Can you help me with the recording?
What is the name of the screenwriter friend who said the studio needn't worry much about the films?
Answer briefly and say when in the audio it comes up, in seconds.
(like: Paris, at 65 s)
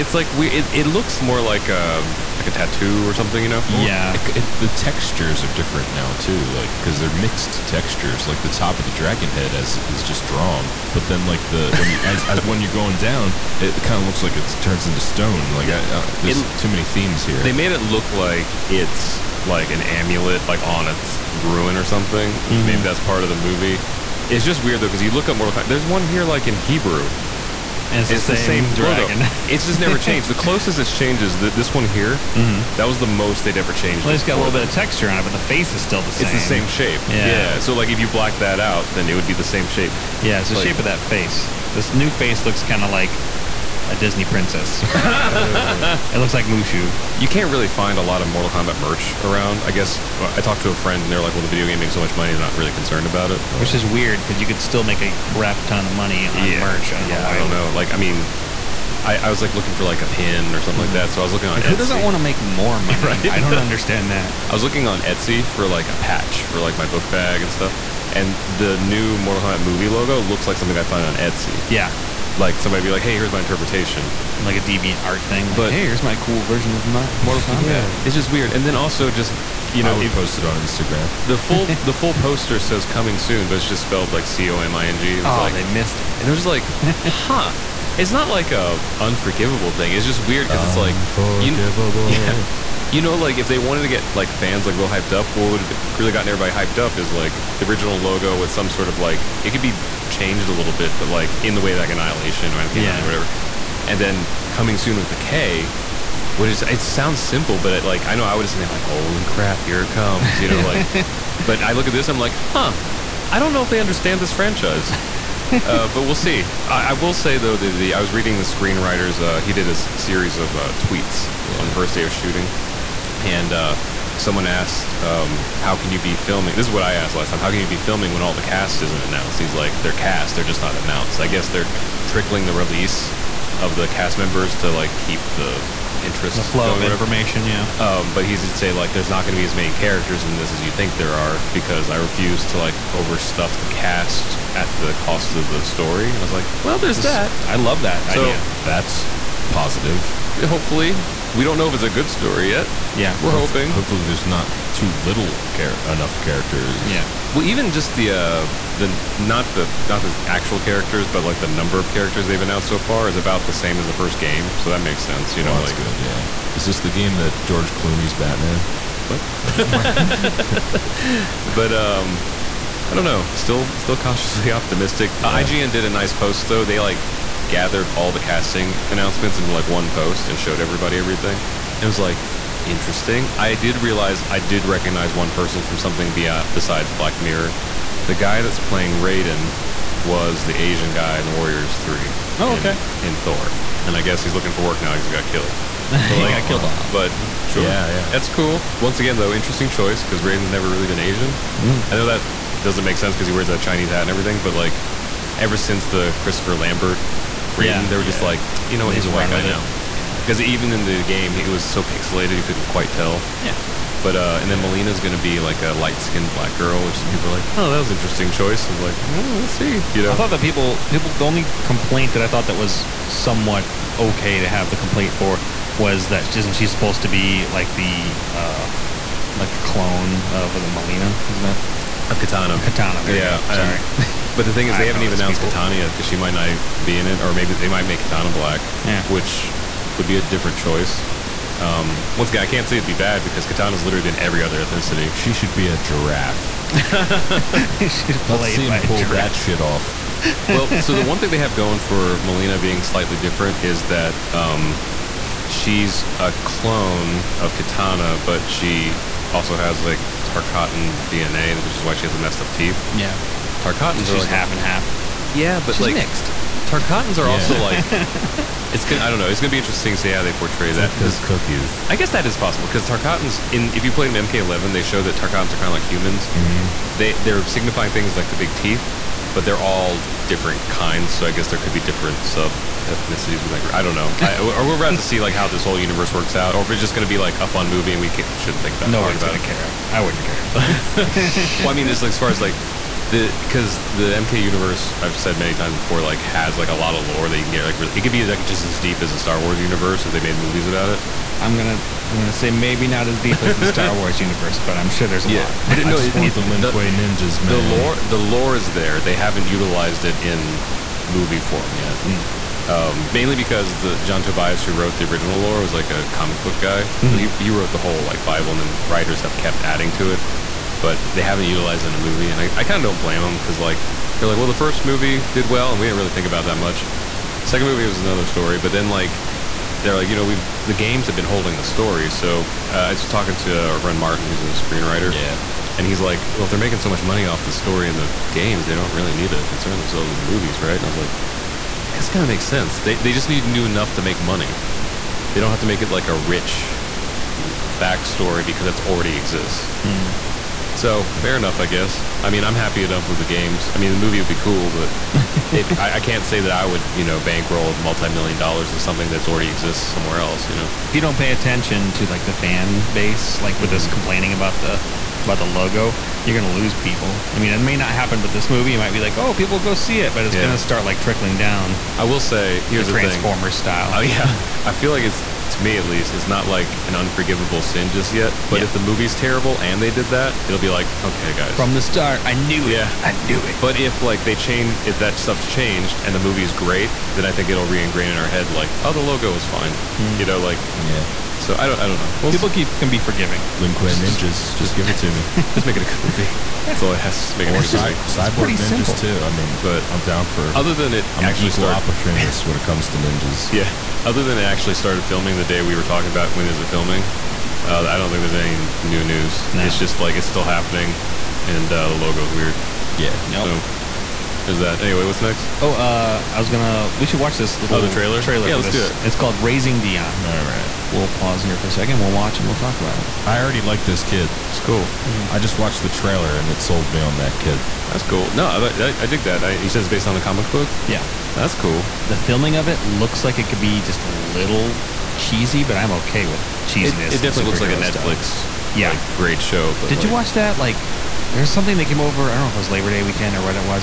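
Martin, at 333 s.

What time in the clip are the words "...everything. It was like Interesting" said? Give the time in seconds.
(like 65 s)
180 s.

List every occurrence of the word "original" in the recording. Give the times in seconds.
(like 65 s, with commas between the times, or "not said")
97 s, 315 s.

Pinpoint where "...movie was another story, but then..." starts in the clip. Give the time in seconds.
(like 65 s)
327 s.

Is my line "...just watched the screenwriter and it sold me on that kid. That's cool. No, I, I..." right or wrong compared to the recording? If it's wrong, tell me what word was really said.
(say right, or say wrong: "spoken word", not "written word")
wrong: "trailer", not "screenwriter".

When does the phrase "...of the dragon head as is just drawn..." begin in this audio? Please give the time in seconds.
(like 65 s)
8 s.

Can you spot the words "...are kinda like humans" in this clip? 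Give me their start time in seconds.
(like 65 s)
275 s.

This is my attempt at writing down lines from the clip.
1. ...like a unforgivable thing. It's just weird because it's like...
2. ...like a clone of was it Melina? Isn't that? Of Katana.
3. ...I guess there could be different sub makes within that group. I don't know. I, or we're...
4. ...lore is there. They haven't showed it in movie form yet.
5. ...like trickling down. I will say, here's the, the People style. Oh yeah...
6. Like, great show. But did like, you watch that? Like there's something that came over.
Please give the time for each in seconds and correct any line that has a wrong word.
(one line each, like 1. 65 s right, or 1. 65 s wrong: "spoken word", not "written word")
1. 88 s right
2. 229 s right
3. 281 s wrong: "ethnicities", not "makes"
4. 308 s wrong: "utilized", not "showed"
5. 370 s wrong: "Transformer", not "People"
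6. 438 s right.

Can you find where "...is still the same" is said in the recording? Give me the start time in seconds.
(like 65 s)
35 s.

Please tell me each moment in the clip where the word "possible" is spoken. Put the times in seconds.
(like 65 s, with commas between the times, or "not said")
272 s.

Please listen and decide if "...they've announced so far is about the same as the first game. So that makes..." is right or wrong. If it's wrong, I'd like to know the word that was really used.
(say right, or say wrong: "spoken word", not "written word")
right.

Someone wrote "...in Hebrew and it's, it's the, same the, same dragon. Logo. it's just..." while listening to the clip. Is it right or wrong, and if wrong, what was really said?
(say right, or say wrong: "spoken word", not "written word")
right.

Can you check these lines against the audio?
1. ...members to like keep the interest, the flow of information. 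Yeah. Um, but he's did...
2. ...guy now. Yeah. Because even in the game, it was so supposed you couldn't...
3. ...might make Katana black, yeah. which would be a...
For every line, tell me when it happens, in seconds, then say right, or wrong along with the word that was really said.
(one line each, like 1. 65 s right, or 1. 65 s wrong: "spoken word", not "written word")
1. 134 s right
2. 209 s wrong: "pixelated", not "supposed"
3. 237 s right.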